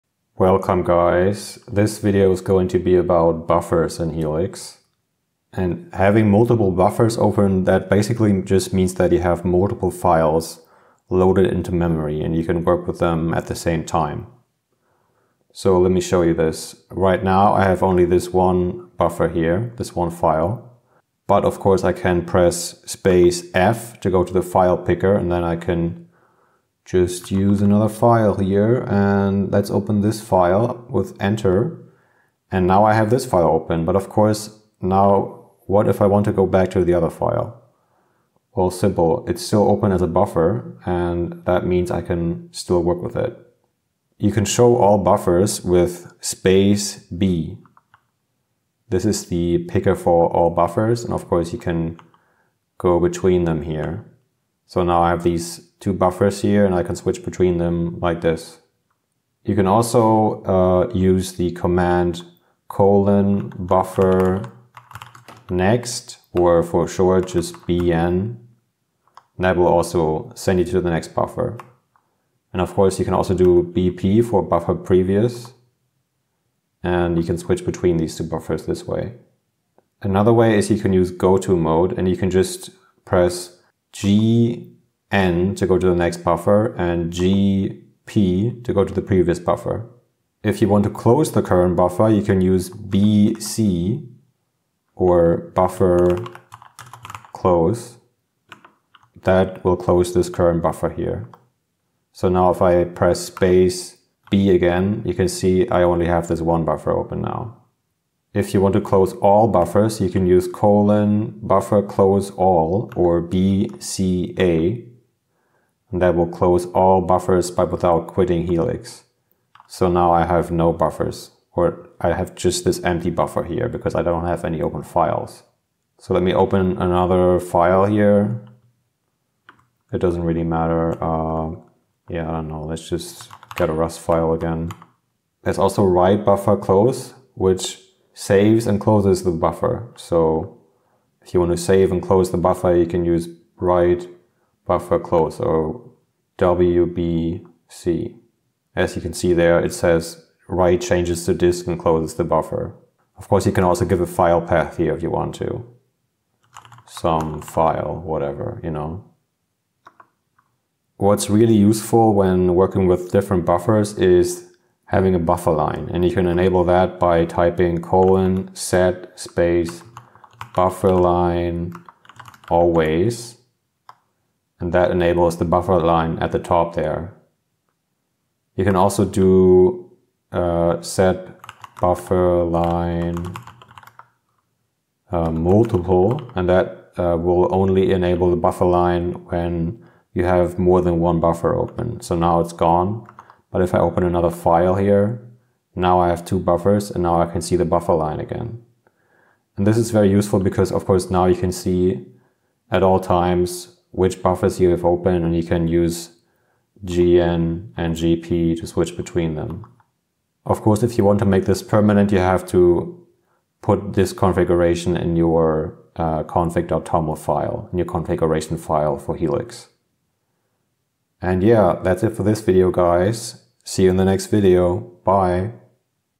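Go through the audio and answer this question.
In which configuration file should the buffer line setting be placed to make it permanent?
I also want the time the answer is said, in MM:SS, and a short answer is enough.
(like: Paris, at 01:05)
config.toml, at 03:36.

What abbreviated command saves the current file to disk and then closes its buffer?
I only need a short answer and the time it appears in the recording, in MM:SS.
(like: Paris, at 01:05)
WBC, at 02:26.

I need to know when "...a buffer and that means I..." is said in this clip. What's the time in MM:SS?
00:40.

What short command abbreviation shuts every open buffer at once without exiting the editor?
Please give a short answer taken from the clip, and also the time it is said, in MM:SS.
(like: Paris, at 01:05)
BCA, at 01:53.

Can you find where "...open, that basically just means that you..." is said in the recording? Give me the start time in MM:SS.
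00:07.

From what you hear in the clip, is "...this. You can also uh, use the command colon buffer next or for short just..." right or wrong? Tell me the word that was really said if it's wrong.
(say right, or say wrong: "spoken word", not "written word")
right.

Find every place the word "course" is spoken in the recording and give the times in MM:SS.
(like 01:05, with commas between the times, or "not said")
00:21, 00:34, 00:51, 01:12, 02:33, 03:20, 03:30.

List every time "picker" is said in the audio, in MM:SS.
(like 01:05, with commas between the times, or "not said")
00:24, 00:49.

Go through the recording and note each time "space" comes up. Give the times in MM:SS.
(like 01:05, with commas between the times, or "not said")
00:22, 00:46, 01:43, 02:49.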